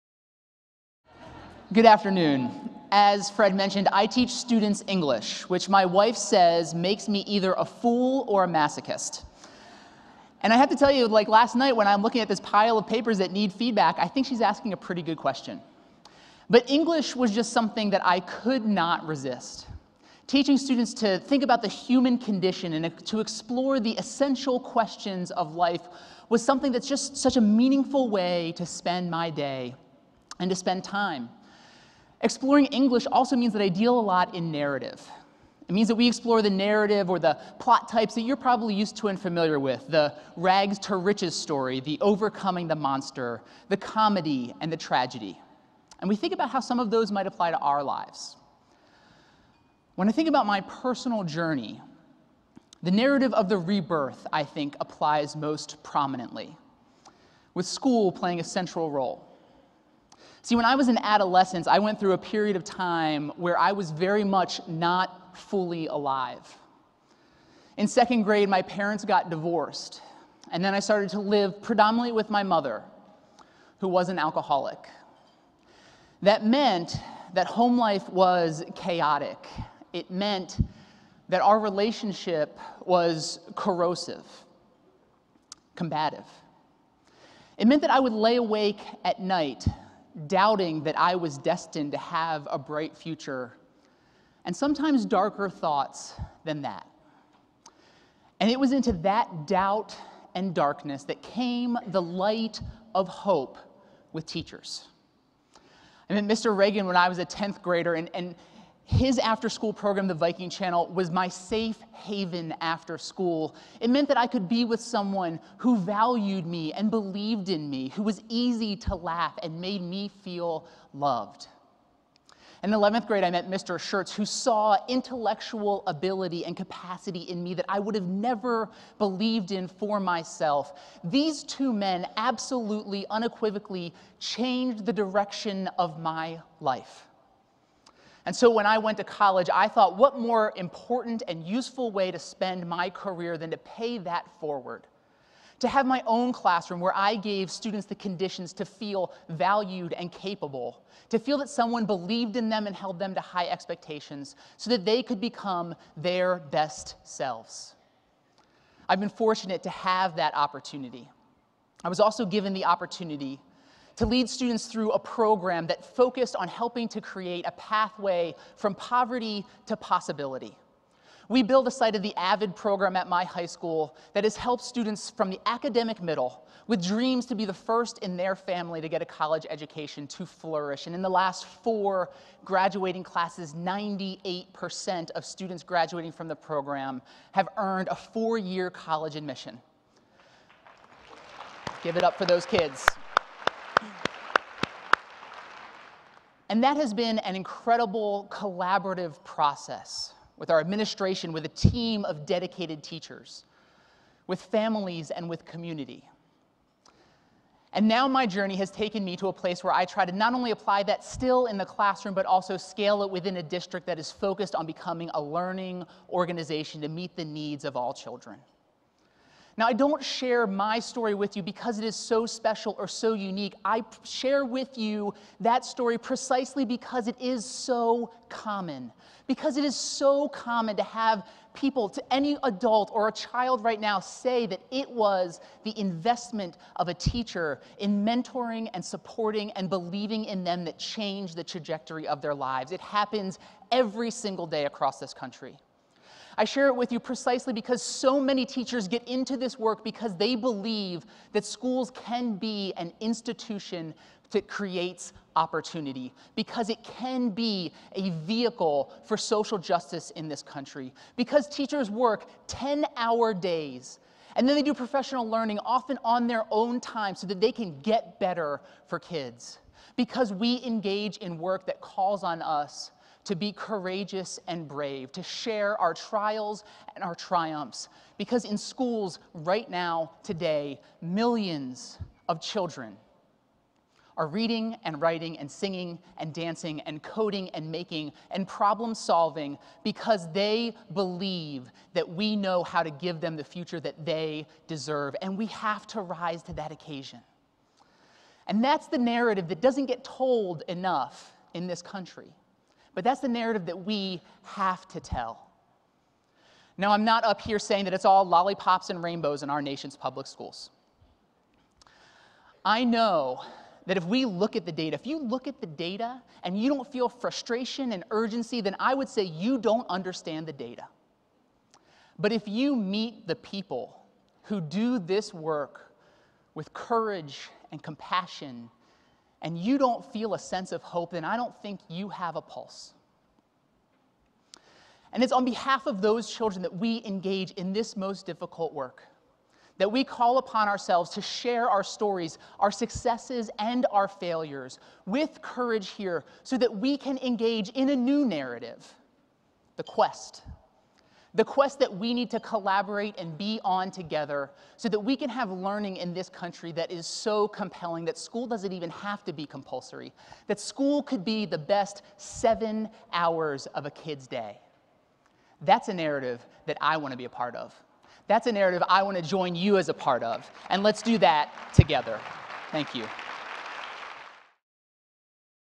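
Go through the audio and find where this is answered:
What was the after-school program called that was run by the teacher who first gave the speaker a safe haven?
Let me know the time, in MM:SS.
01:50.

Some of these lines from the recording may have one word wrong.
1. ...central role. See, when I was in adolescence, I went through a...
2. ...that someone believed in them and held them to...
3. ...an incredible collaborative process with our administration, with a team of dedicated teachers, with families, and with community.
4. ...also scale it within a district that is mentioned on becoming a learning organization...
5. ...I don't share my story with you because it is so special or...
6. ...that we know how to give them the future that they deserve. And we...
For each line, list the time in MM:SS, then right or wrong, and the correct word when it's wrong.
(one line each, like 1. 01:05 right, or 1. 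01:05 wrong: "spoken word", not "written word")
1. 00:58 right
2. 02:31 right
3. 03:17 right
4. 03:32 wrong: "focused", not "mentioned"
5. 03:39 right
6. 04:51 right.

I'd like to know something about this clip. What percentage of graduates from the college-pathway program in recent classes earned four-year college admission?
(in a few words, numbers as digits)
98%.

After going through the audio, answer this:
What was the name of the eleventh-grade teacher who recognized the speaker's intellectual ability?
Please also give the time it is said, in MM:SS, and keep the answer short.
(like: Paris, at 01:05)
Mr. Schertz, at 02:03.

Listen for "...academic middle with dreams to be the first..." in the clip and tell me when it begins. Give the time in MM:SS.
02:55.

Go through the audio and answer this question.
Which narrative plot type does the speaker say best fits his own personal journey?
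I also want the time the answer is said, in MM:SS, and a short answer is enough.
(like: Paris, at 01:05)
rebirth, at 00:53.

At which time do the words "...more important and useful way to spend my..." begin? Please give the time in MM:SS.
02:20.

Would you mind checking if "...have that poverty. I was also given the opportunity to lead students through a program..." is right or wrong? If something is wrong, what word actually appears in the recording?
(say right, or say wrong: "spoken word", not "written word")
wrong: "opportunity", not "poverty".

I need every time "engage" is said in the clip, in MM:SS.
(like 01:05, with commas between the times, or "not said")
04:30, 05:37, 05:47.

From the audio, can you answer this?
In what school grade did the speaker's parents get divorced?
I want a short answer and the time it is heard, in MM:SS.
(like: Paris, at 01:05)
second grade, at 01:07.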